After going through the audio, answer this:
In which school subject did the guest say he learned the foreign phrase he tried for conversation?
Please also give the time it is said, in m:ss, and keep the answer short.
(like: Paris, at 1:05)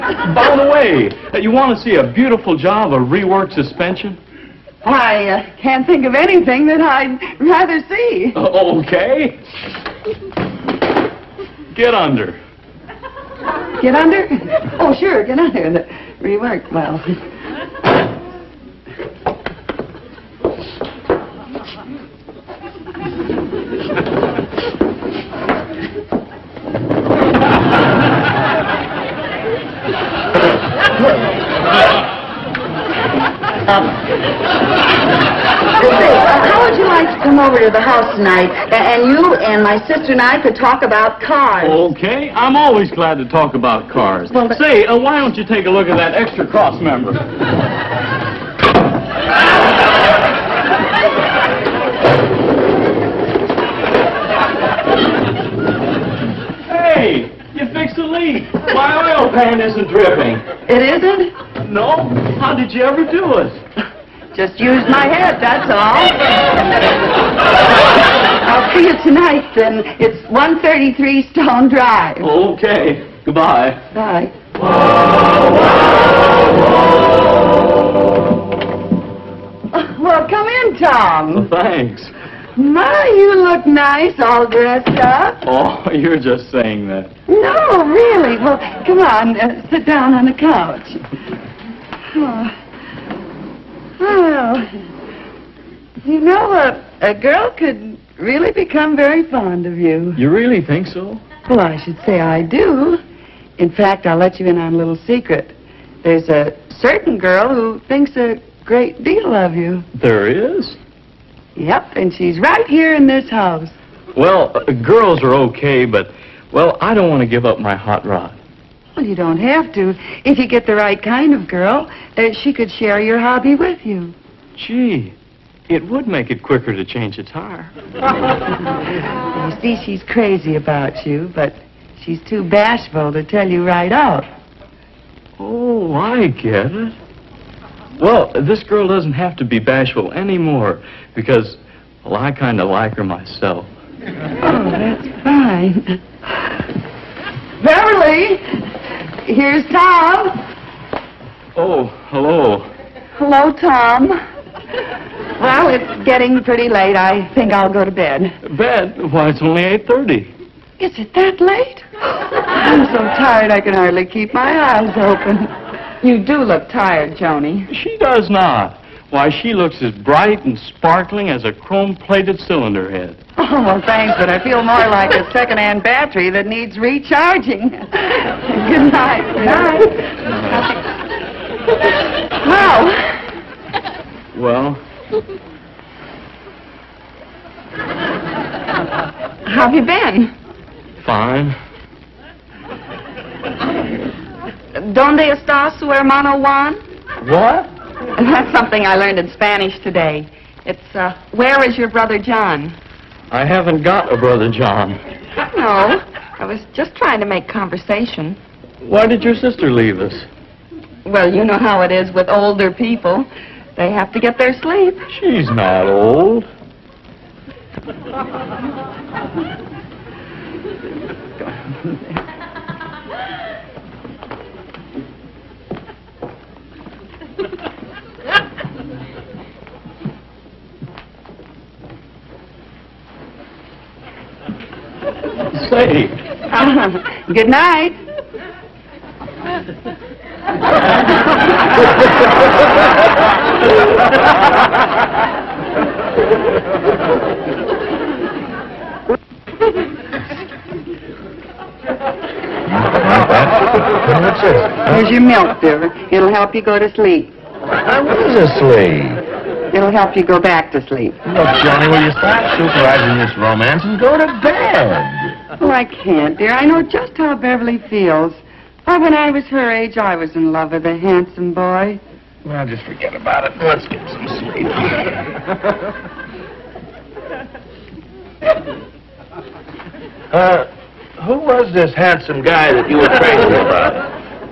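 Spanish, at 3:19.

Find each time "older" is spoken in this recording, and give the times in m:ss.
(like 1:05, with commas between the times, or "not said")
3:32.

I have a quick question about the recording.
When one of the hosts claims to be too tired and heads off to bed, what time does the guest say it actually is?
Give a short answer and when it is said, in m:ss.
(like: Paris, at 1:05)
8:30, at 2:39.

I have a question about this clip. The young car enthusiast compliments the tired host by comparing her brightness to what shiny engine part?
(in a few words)
chrome-plated cylinder head.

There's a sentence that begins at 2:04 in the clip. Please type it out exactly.
Gee, it would make it quicker to change a tire.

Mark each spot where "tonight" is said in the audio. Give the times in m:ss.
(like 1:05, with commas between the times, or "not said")
0:38, 1:09.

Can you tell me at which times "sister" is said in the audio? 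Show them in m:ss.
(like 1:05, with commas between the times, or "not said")
0:39, 3:29.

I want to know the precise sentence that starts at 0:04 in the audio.
I uh, can't think of anything that I'd rather see.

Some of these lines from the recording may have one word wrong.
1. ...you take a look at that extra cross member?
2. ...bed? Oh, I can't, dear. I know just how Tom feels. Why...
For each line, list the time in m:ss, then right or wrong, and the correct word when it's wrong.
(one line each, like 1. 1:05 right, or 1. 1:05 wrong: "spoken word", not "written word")
1. 0:45 right
2. 4:24 wrong: "Beverly", not "Tom".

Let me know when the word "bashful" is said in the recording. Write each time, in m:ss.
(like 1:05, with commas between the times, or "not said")
2:12, 2:19.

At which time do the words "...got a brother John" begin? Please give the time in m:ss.
3:23.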